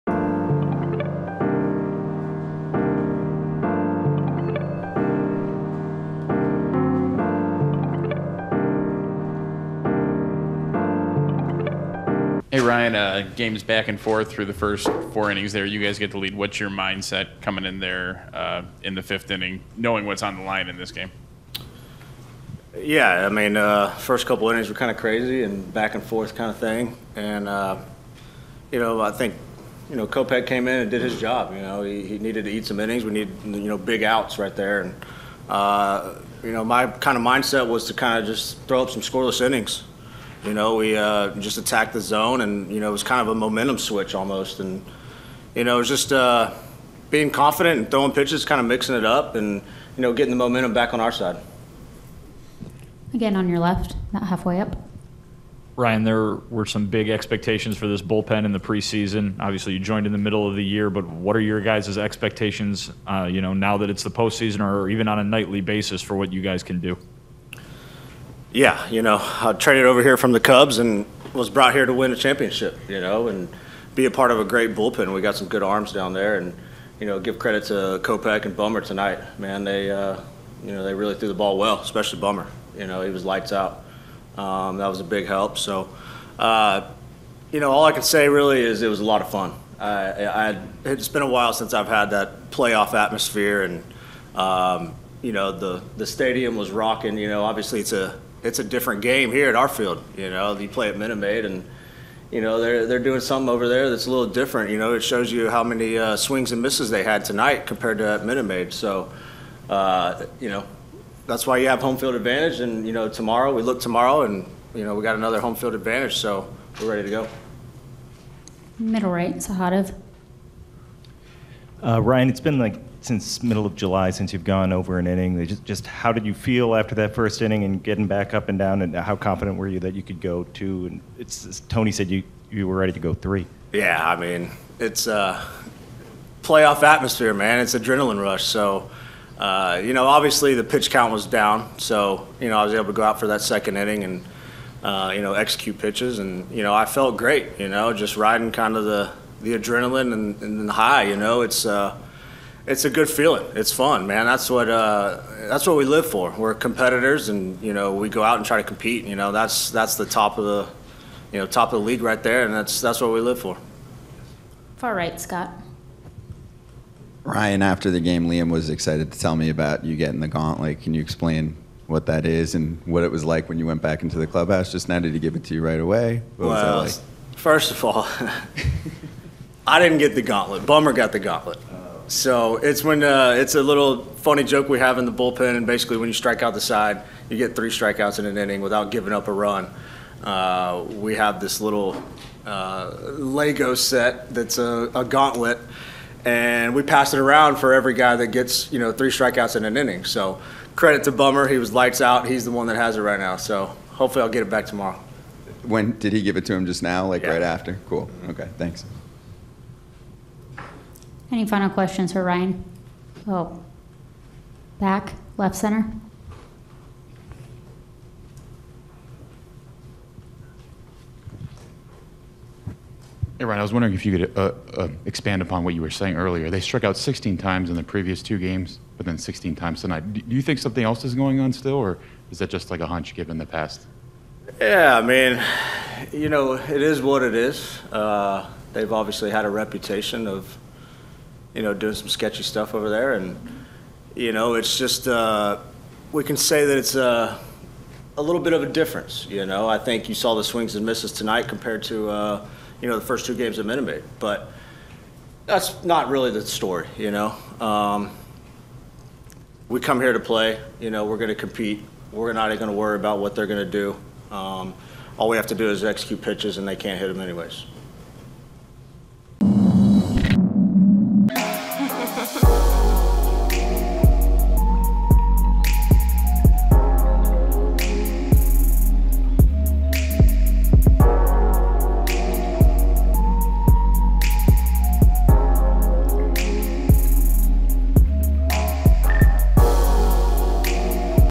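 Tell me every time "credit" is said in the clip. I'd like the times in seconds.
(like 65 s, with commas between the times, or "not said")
77 s, 200 s.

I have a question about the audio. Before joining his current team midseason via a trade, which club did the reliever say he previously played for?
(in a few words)
Cubs.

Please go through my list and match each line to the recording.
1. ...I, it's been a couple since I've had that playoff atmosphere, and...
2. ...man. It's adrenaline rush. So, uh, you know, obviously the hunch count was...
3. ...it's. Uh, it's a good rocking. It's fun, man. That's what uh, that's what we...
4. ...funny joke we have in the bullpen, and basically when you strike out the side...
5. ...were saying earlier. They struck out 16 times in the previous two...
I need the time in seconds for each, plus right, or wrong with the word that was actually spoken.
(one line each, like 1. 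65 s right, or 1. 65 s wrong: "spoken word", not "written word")
1. 90 s wrong: "while", not "couple"
2. 137 s wrong: "pitch", not "hunch"
3. 151 s wrong: "feeling", not "rocking"
4. 184 s right
5. 225 s right.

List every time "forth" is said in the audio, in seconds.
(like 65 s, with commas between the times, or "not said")
13 s, 26 s.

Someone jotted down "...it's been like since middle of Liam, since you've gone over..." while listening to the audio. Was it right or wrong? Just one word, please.
wrong.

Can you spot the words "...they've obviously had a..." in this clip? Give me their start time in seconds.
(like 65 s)
238 s.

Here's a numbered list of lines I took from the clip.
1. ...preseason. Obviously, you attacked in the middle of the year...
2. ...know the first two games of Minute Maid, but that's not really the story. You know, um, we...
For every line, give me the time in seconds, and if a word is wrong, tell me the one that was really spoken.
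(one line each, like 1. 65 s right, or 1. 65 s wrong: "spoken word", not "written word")
1. 58 s wrong: "joined", not "attacked"
2. 252 s right.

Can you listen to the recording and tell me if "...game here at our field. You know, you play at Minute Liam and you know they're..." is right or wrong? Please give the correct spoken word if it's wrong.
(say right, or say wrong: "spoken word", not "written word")
wrong: "Maid", not "Liam".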